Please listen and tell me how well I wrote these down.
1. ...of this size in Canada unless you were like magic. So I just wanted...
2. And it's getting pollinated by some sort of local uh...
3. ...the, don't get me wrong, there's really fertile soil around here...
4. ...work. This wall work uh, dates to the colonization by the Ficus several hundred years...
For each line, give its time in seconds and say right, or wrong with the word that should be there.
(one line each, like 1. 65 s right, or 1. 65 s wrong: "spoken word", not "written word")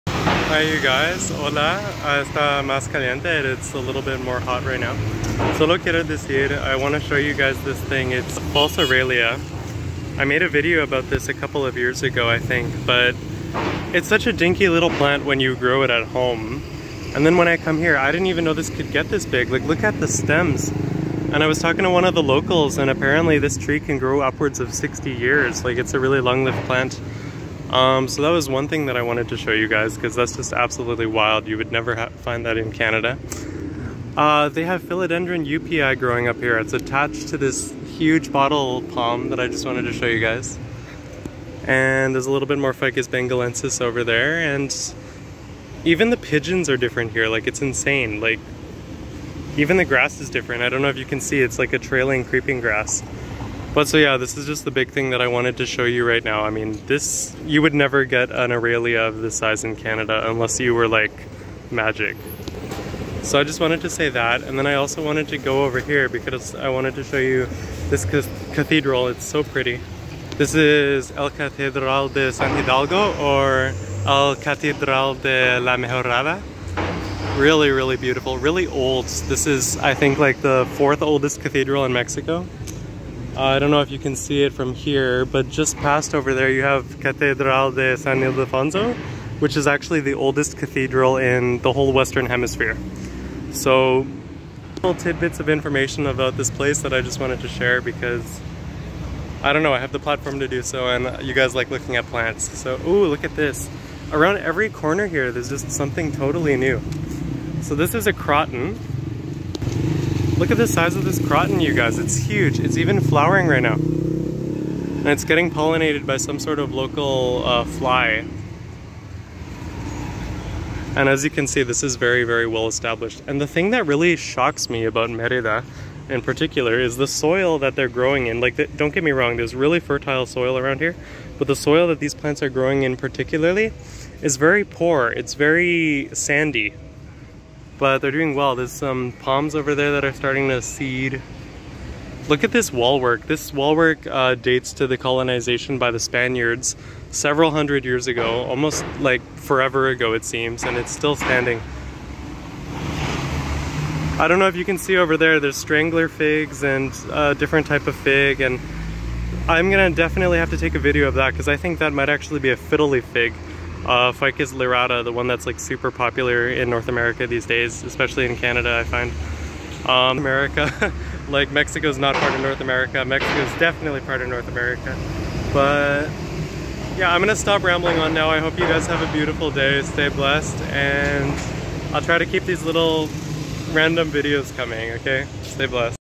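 1. 59 s right
2. 113 s right
3. 128 s right
4. 143 s wrong: "Spaniards", not "Ficus".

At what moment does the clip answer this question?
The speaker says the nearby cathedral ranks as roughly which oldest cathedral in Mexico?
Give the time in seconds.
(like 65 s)
80 s.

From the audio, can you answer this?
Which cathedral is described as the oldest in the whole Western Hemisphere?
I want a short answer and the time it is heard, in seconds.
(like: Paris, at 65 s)
Catedral de San Ildefonso, at 86 s.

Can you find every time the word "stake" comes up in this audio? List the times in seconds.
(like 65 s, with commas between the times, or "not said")
not said.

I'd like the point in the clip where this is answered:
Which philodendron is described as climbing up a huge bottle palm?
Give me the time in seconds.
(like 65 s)
34 s.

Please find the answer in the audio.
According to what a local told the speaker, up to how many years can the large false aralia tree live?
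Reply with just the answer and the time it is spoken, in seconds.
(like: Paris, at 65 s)
60, at 24 s.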